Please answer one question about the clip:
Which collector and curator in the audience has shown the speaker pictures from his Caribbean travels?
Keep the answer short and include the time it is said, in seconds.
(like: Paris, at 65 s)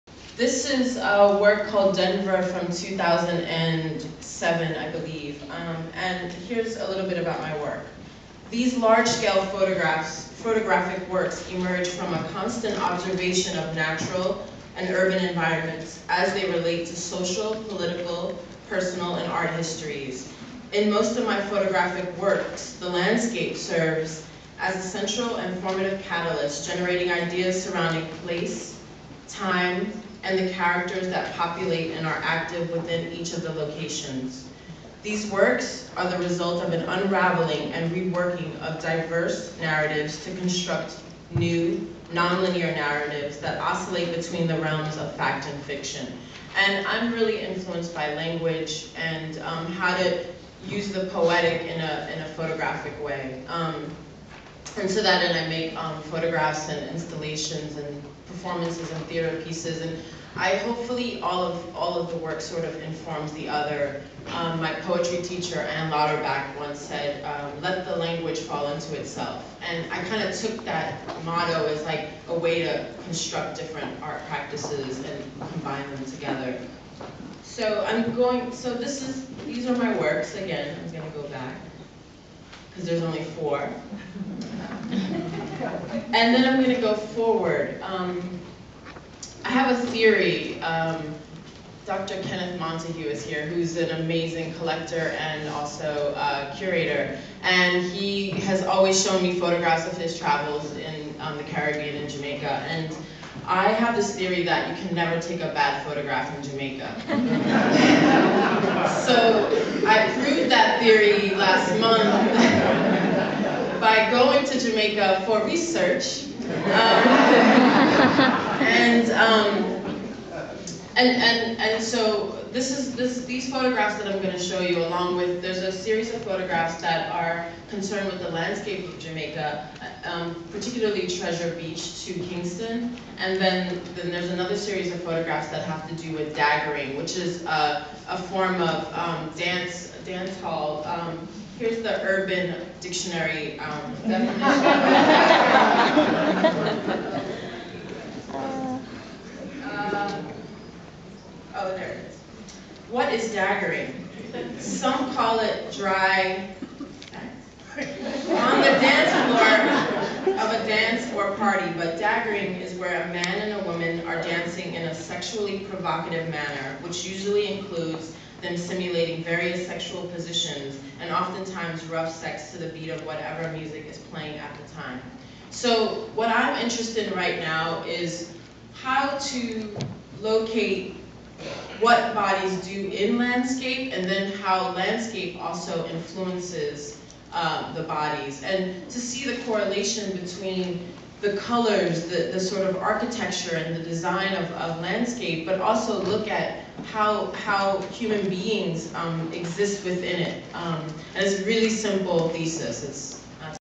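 Dr. Kenneth Montague, at 91 s.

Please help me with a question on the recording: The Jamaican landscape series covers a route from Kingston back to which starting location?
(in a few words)
Treasure Beach.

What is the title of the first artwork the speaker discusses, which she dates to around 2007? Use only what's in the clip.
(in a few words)
Denver.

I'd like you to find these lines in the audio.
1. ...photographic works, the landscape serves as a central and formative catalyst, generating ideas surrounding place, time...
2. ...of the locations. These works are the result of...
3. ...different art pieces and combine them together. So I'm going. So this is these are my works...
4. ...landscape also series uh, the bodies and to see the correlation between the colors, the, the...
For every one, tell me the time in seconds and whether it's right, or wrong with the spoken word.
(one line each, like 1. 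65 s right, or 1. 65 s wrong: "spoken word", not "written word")
1. 21 s right
2. 33 s right
3. 73 s wrong: "practices", not "pieces"
4. 184 s wrong: "influences", not "series".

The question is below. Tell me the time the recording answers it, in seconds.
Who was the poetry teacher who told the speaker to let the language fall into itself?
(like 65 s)
65 s.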